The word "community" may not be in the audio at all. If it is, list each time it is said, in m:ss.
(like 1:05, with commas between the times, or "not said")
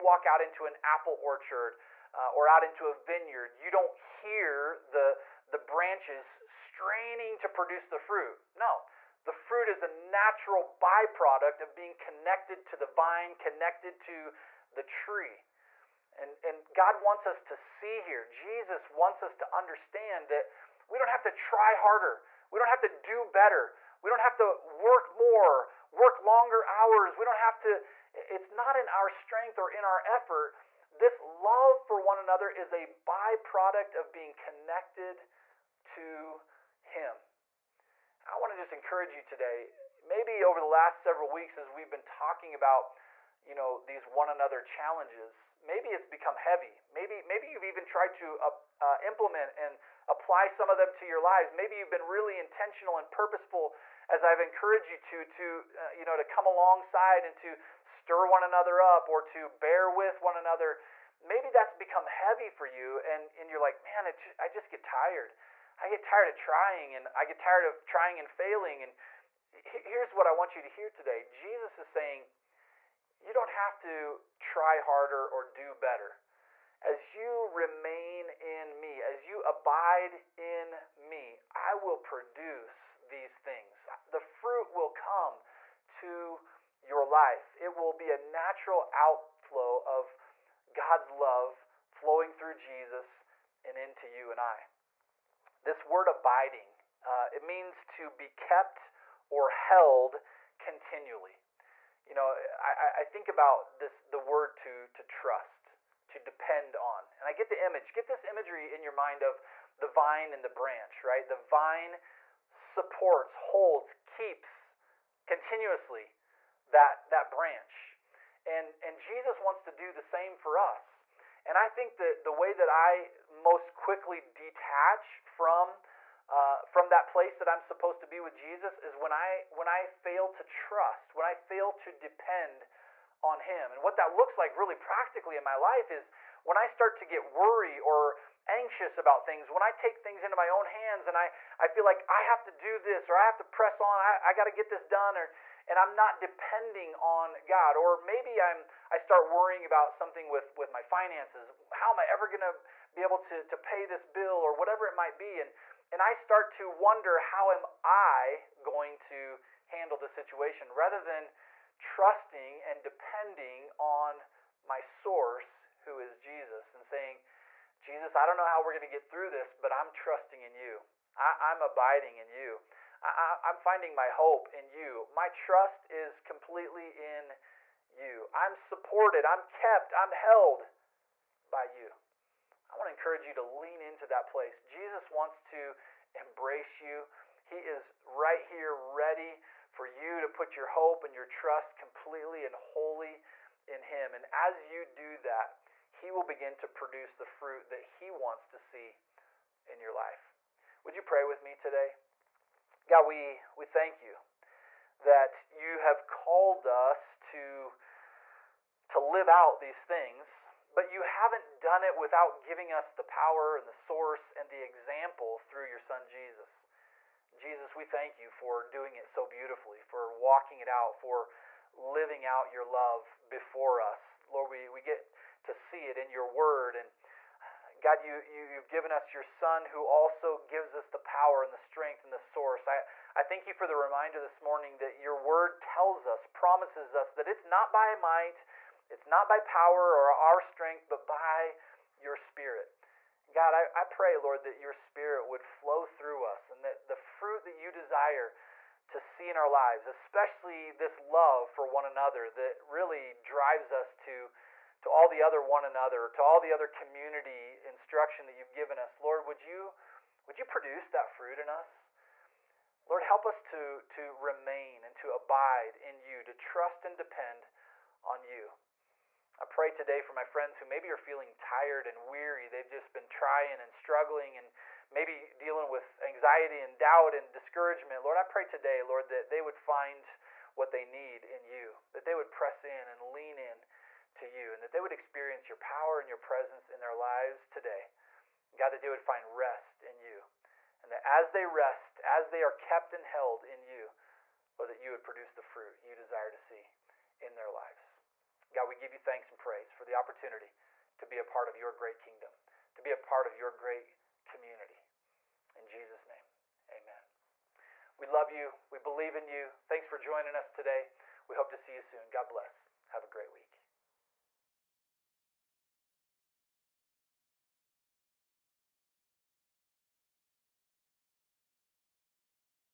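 4:16, 5:04.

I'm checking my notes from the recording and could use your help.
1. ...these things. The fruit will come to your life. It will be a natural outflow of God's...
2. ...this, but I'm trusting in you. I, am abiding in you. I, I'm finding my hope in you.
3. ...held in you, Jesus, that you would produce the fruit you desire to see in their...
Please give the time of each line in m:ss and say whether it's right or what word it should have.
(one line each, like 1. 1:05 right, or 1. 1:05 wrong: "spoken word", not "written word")
1. 1:23 right
2. 2:49 right
3. 4:53 wrong: "Lord", not "Jesus".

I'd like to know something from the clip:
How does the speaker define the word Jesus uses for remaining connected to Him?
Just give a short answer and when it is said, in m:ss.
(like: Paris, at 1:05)
continually, at 1:40.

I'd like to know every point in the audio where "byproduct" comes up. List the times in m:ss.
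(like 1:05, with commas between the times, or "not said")
0:10, 0:32.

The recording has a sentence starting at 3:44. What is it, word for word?
Lord, we, we get to see it in your word.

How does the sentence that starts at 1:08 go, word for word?
And here's what I want you to hear today: Jesus is saying, you don't have to try harder or do better.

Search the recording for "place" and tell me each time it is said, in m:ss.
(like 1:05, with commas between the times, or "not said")
2:07, 3:04.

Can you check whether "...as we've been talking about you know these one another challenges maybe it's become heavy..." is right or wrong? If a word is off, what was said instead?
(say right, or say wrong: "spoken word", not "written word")
right.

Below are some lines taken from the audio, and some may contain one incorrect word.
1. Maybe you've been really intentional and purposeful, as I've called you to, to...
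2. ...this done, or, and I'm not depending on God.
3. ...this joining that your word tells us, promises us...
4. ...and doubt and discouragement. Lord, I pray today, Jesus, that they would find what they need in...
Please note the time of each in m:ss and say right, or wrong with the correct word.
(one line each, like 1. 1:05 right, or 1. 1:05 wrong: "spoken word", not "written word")
1. 0:51 wrong: "encouraged", not "called"
2. 2:24 right
3. 3:54 wrong: "morning", not "joining"
4. 4:36 wrong: "Lord", not "Jesus".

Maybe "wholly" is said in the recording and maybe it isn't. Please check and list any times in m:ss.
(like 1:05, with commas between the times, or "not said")
3:12.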